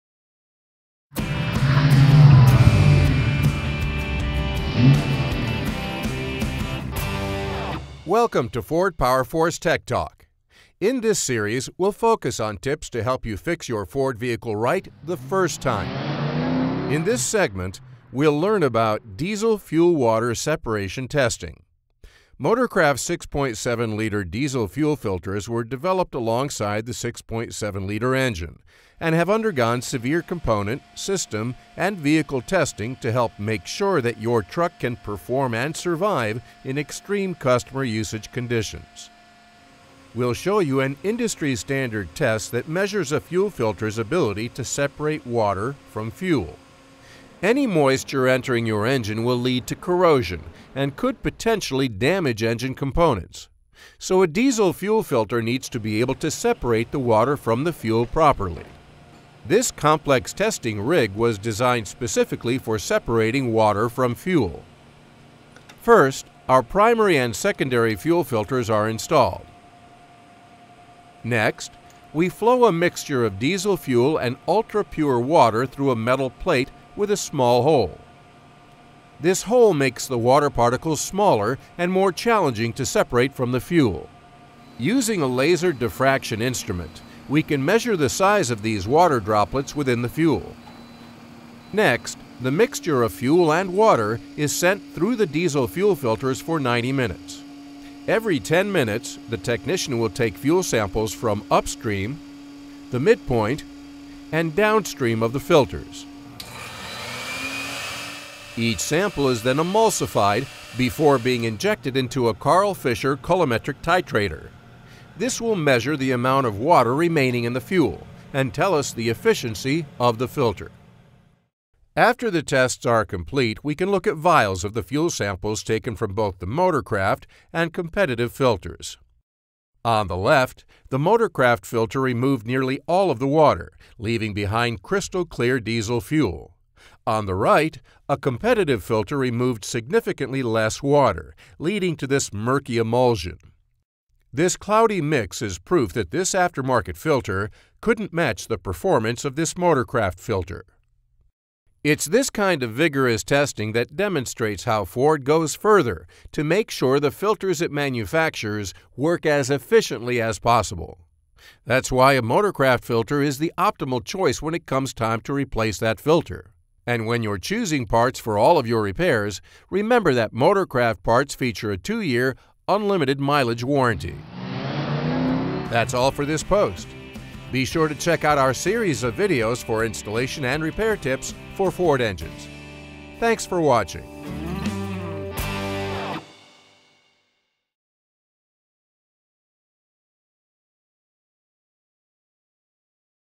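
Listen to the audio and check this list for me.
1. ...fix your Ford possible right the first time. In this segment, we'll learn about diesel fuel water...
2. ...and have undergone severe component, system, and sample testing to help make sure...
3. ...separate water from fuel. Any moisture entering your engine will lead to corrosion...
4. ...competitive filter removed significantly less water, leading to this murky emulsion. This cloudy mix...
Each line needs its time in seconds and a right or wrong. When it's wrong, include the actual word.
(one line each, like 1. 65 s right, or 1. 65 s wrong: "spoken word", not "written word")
1. 13 s wrong: "vehicle", not "possible"
2. 28 s wrong: "vehicle", not "sample"
3. 44 s right
4. 138 s right.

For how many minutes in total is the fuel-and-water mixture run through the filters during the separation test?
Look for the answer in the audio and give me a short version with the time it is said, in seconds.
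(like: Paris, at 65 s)
90 minutes, at 96 s.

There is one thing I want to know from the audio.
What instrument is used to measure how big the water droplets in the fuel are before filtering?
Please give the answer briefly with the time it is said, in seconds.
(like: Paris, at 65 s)
Laser diffraction instrument, at 85 s.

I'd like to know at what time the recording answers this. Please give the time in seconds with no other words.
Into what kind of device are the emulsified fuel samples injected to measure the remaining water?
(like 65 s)
112 s.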